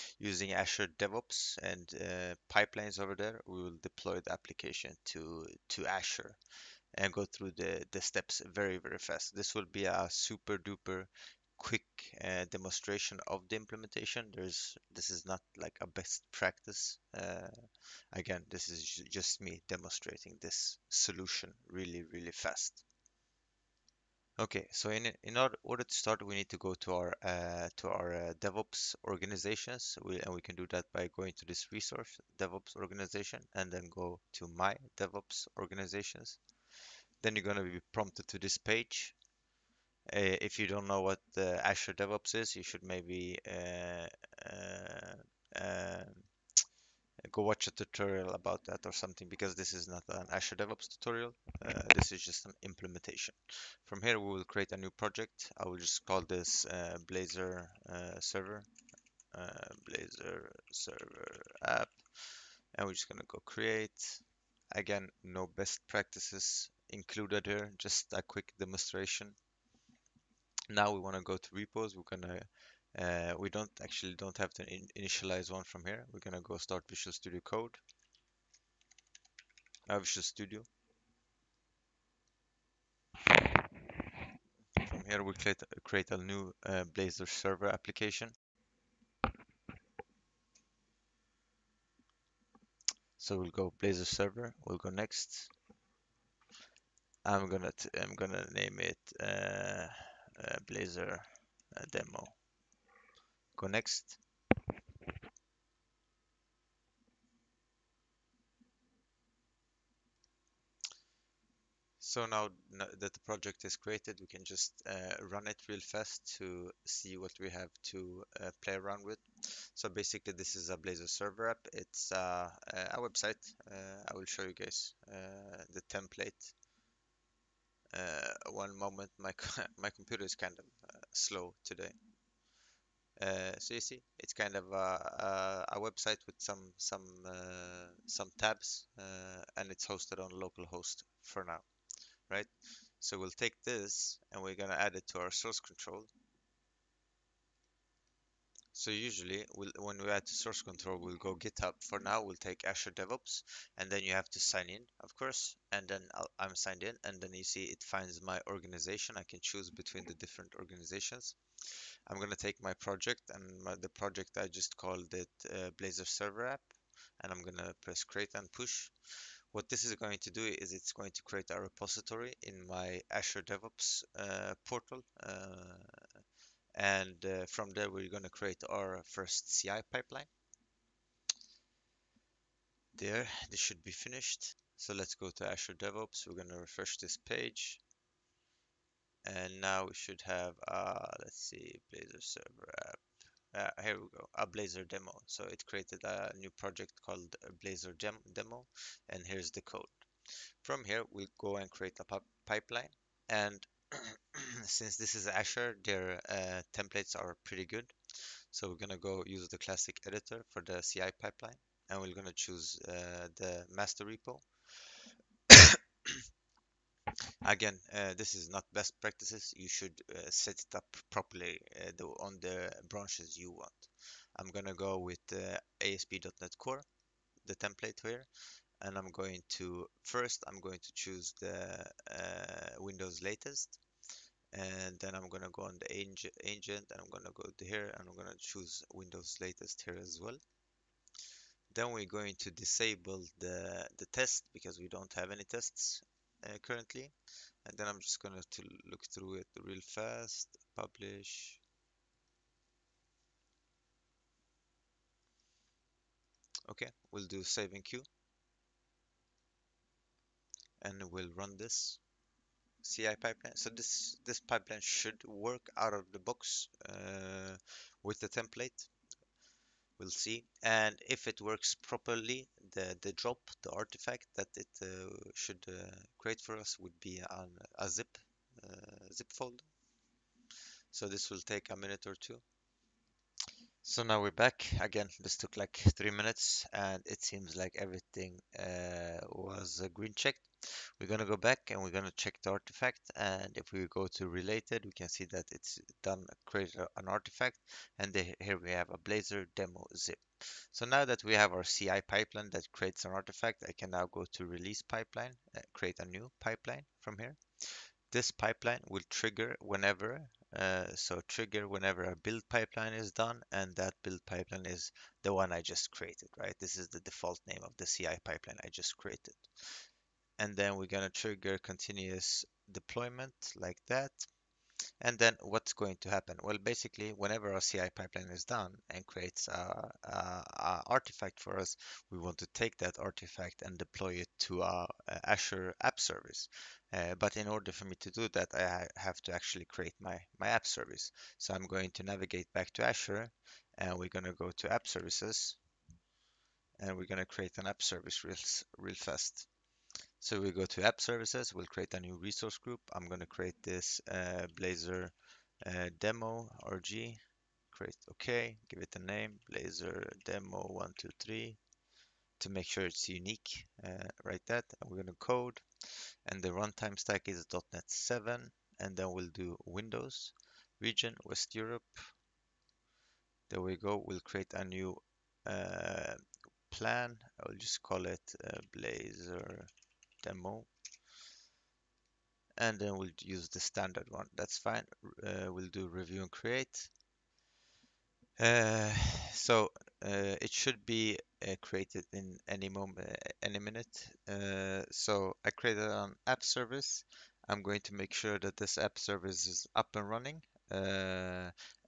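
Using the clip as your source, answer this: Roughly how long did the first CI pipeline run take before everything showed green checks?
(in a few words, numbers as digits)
3 minutes.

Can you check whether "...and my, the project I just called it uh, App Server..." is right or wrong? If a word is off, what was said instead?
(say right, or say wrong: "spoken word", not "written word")
wrong: "Blazor", not "App".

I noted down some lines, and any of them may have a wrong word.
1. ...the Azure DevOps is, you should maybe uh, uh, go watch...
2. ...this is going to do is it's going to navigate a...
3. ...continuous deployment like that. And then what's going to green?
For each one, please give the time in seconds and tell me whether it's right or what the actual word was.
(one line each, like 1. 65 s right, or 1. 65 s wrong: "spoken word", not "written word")
1. 41 s right
2. 169 s wrong: "create", not "navigate"
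3. 321 s wrong: "happen", not "green".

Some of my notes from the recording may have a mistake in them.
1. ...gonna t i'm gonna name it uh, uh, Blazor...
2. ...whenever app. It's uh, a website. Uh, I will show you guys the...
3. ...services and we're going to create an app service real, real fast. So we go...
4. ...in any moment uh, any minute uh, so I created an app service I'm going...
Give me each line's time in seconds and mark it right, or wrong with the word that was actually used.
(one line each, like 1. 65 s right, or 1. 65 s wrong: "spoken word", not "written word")
1. 97 s right
2. 121 s wrong: "server", not "whenever"
3. 344 s right
4. 392 s right.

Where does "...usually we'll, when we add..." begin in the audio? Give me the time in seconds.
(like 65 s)
148 s.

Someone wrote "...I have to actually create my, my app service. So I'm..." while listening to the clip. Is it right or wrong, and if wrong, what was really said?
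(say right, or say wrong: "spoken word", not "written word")
right.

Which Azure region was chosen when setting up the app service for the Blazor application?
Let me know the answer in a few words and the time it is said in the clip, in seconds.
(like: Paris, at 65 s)
West Europe, at 371 s.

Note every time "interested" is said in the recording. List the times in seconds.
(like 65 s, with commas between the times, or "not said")
not said.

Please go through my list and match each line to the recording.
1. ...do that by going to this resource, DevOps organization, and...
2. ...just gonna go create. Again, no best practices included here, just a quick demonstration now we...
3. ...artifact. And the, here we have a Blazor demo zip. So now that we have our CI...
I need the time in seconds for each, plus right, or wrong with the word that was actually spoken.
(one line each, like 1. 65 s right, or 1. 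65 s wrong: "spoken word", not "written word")
1. 30 s right
2. 62 s right
3. 297 s right.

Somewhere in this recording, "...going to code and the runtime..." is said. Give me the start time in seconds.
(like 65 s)
365 s.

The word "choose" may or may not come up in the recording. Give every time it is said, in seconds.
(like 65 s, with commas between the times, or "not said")
159 s, 212 s, 230 s, 238 s.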